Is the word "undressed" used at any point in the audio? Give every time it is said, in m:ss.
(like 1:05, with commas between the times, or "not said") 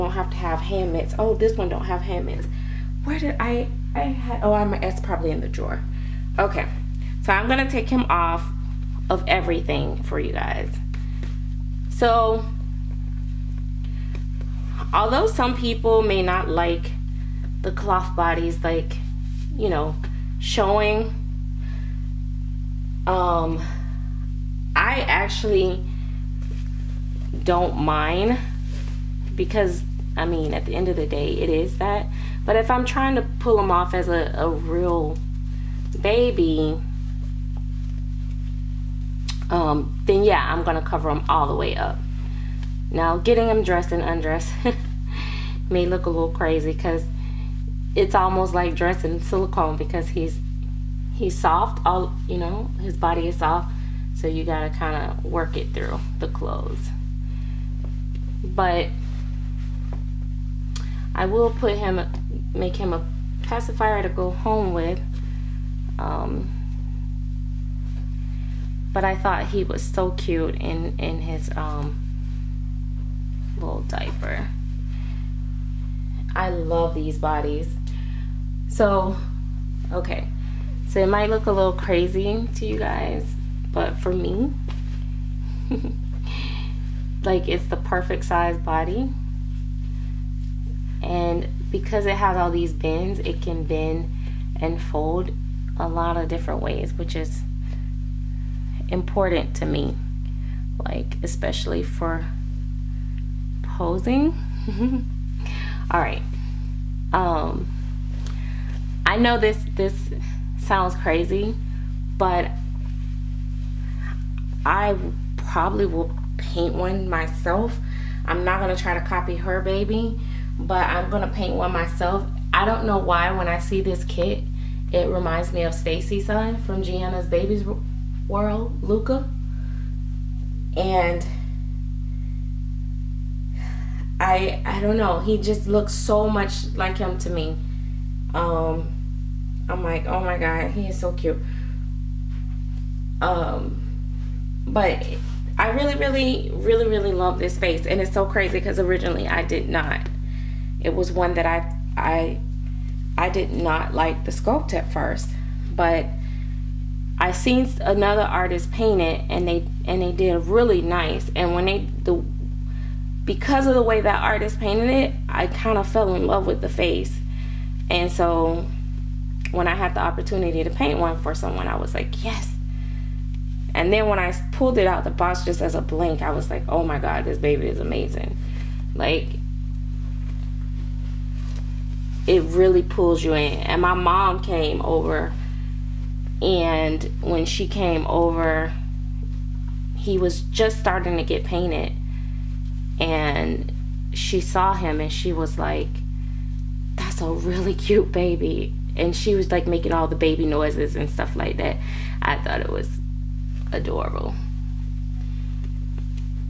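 0:44.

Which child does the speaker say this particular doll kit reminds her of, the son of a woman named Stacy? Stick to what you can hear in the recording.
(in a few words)
Luca.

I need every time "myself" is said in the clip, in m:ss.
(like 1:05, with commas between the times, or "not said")
1:57, 2:01.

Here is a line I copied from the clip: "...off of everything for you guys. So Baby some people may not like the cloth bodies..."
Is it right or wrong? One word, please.
wrong.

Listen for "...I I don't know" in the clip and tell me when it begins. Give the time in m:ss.
2:14.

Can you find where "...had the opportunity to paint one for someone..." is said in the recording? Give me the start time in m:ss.
2:49.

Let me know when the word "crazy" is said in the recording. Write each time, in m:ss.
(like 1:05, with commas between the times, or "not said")
0:46, 1:21, 1:50, 2:28.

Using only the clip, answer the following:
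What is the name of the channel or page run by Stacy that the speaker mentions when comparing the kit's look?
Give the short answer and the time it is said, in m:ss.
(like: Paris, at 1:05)
Gianna's Baby's World, at 2:06.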